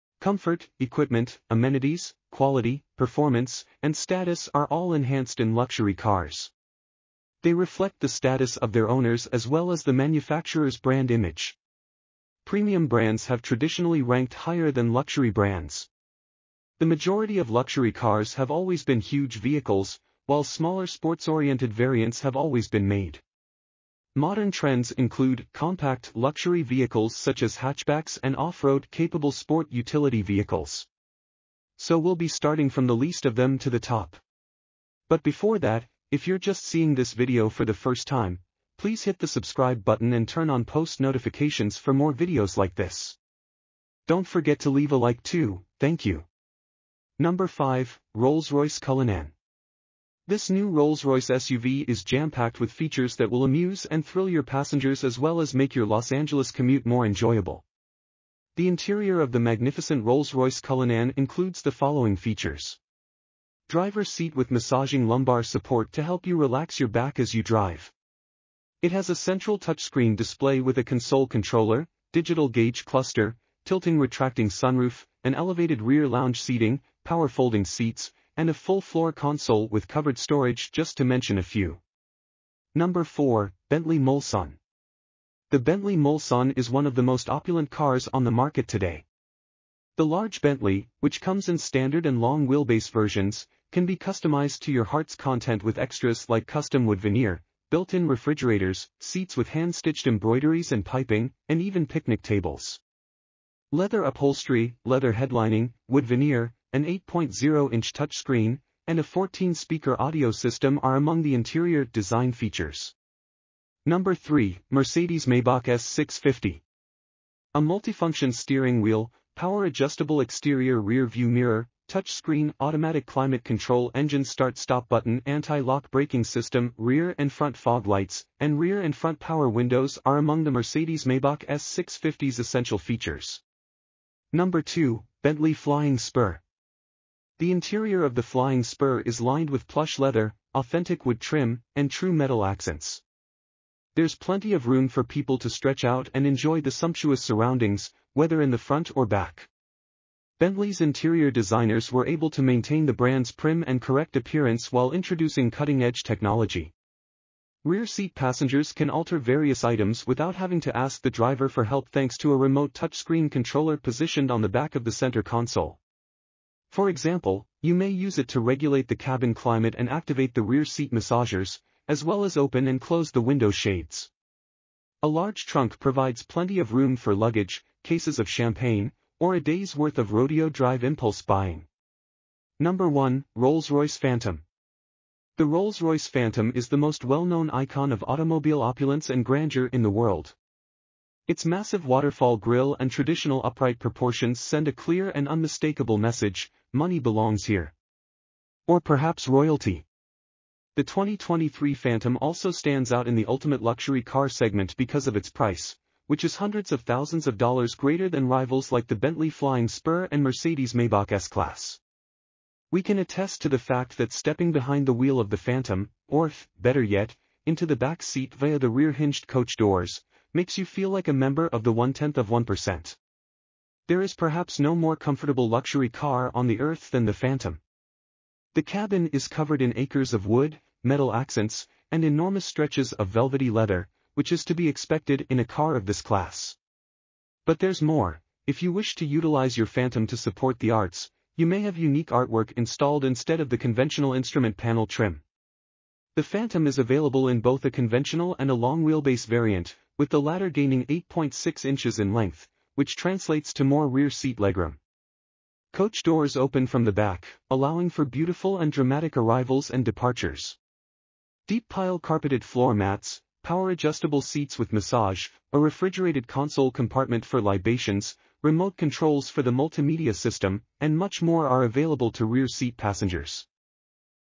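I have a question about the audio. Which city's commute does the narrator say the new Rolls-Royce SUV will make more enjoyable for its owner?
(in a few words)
Los Angeles.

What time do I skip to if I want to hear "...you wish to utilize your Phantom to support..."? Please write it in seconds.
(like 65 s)
238 s.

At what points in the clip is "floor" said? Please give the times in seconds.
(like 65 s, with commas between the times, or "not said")
78 s, 262 s.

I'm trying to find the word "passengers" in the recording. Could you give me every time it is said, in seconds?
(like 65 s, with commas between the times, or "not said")
54 s, 158 s, 272 s.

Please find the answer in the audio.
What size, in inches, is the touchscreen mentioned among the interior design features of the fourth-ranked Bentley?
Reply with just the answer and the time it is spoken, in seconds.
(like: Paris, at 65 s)
8.0 inches, at 106 s.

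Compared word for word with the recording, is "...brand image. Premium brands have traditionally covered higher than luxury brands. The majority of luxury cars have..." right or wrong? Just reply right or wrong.
wrong.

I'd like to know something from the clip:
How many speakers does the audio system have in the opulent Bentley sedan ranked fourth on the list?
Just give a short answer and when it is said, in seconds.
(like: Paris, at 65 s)
14, at 109 s.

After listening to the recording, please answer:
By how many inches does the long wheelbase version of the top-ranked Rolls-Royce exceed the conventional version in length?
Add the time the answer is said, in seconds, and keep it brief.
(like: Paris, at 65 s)
8.6 inches, at 250 s.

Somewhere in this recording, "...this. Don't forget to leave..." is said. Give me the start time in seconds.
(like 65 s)
42 s.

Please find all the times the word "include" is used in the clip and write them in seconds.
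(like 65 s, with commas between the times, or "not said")
24 s, 61 s.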